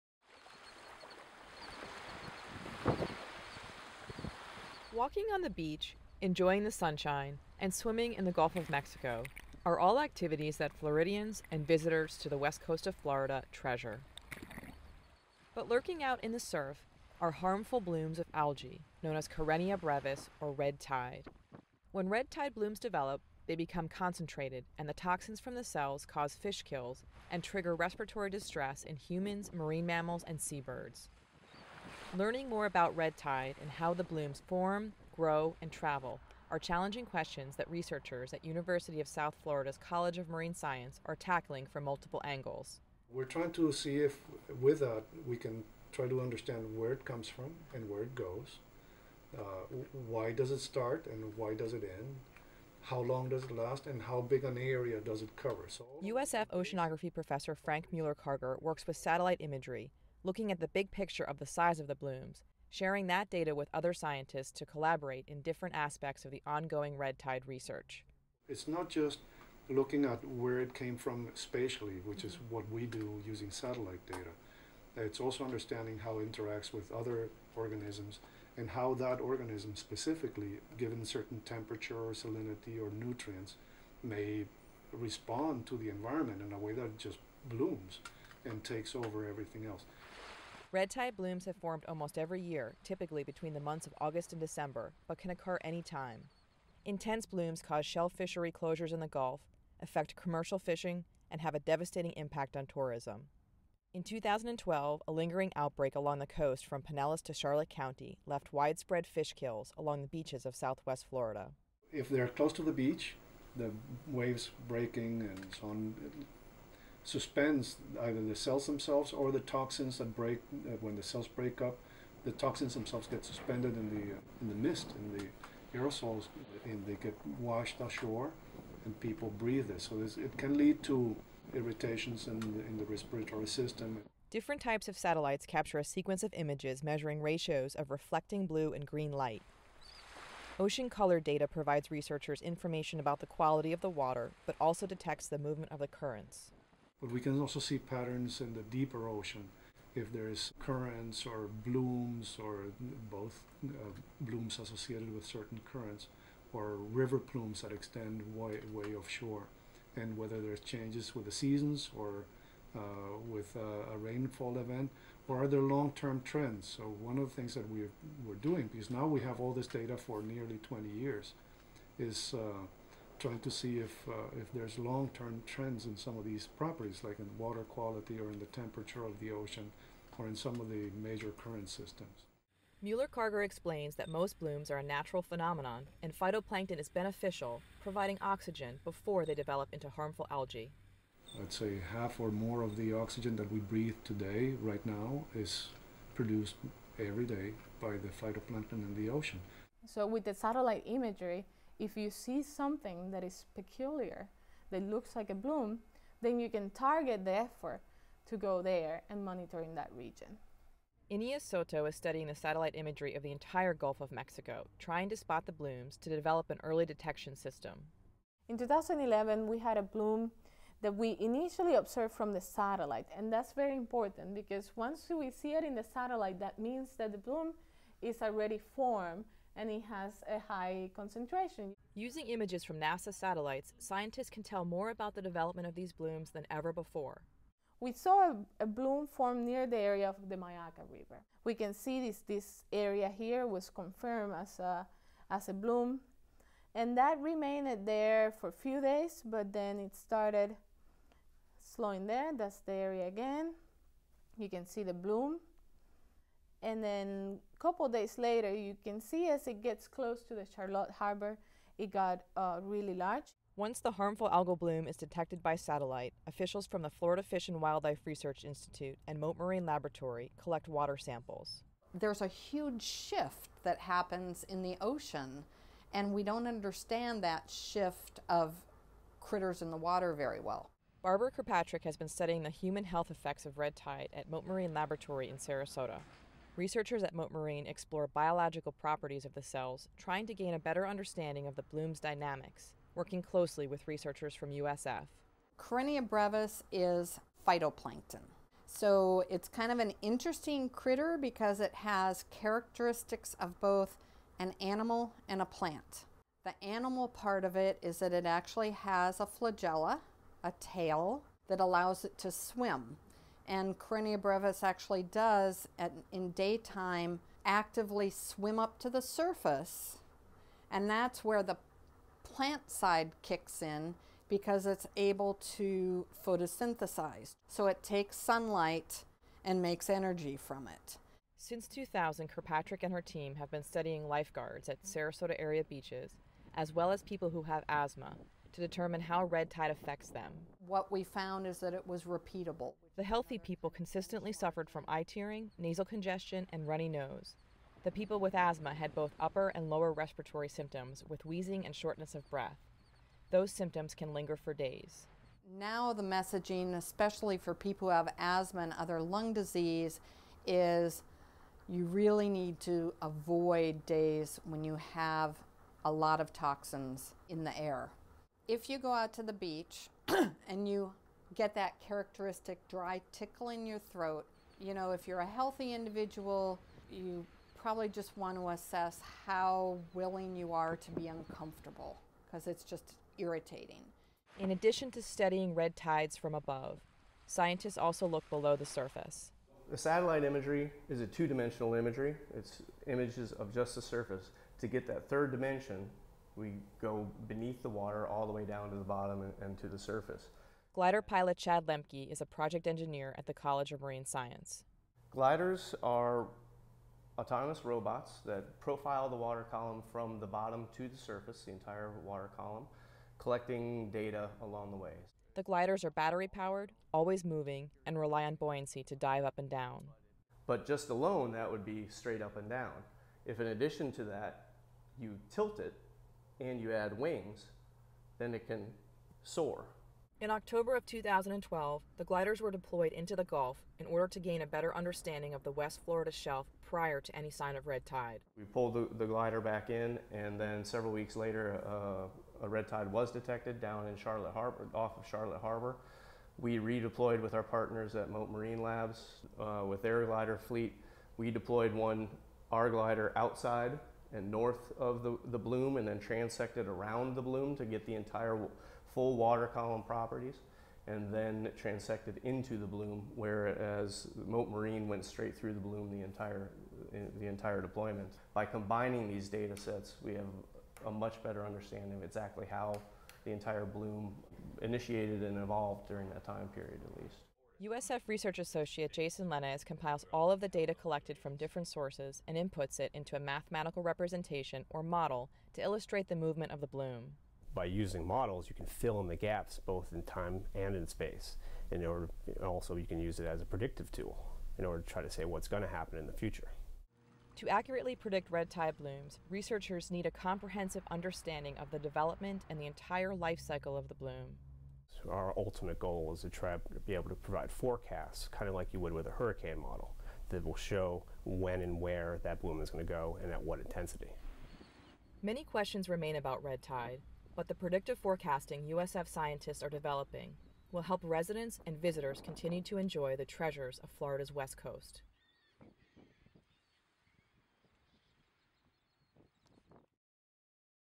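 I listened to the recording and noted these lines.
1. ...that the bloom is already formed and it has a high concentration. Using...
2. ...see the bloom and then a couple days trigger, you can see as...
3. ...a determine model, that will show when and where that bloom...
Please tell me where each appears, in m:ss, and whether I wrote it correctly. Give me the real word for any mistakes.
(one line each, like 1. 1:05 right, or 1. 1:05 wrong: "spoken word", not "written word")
1. 3:46 right
2. 4:14 wrong: "later", not "trigger"
3. 8:29 wrong: "hurricane", not "determine".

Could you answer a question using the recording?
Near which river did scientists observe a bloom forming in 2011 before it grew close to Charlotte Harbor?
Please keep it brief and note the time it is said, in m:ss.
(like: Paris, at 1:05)
Myakka River, at 4:00.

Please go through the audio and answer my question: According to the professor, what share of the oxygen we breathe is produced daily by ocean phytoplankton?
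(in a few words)
half or more.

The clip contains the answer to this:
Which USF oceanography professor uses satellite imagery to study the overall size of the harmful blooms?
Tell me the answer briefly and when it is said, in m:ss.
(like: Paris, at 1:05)
Frank Muller-Karger, at 0:57.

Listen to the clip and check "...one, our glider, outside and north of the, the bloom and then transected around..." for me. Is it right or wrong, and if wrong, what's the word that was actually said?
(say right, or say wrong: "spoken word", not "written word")
right.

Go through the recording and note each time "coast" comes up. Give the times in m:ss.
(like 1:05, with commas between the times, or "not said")
0:12, 1:46, 8:44.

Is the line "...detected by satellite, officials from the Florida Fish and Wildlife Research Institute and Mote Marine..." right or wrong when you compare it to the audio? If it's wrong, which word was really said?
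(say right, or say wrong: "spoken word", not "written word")
right.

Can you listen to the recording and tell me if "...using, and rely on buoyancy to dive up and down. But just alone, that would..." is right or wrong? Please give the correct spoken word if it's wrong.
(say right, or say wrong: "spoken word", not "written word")
wrong: "moving", not "using".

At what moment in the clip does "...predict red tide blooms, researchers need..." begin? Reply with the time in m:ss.
8:17.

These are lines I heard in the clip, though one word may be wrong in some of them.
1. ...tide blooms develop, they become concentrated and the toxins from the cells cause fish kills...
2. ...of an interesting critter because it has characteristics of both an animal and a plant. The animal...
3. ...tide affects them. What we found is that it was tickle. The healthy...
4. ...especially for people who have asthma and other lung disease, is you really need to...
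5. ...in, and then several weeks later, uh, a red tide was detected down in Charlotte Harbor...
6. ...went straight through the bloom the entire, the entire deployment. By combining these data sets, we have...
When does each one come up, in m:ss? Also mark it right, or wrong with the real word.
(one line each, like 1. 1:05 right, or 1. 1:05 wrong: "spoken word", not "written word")
1. 0:22 right
2. 4:59 right
3. 5:39 wrong: "repeatable", not "tickle"
4. 5:56 right
5. 7:19 right
6. 7:44 right.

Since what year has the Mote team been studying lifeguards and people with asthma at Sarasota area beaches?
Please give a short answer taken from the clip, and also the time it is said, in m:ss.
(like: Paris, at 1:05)
2000, at 5:31.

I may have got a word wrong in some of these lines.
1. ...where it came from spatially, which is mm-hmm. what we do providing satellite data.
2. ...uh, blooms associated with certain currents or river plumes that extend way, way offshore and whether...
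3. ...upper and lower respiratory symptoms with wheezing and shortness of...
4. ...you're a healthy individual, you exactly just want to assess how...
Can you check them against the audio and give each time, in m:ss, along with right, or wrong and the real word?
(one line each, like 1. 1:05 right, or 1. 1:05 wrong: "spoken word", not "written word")
1. 1:10 wrong: "using", not "providing"
2. 2:33 right
3. 5:49 right
4. 6:15 wrong: "probably", not "exactly".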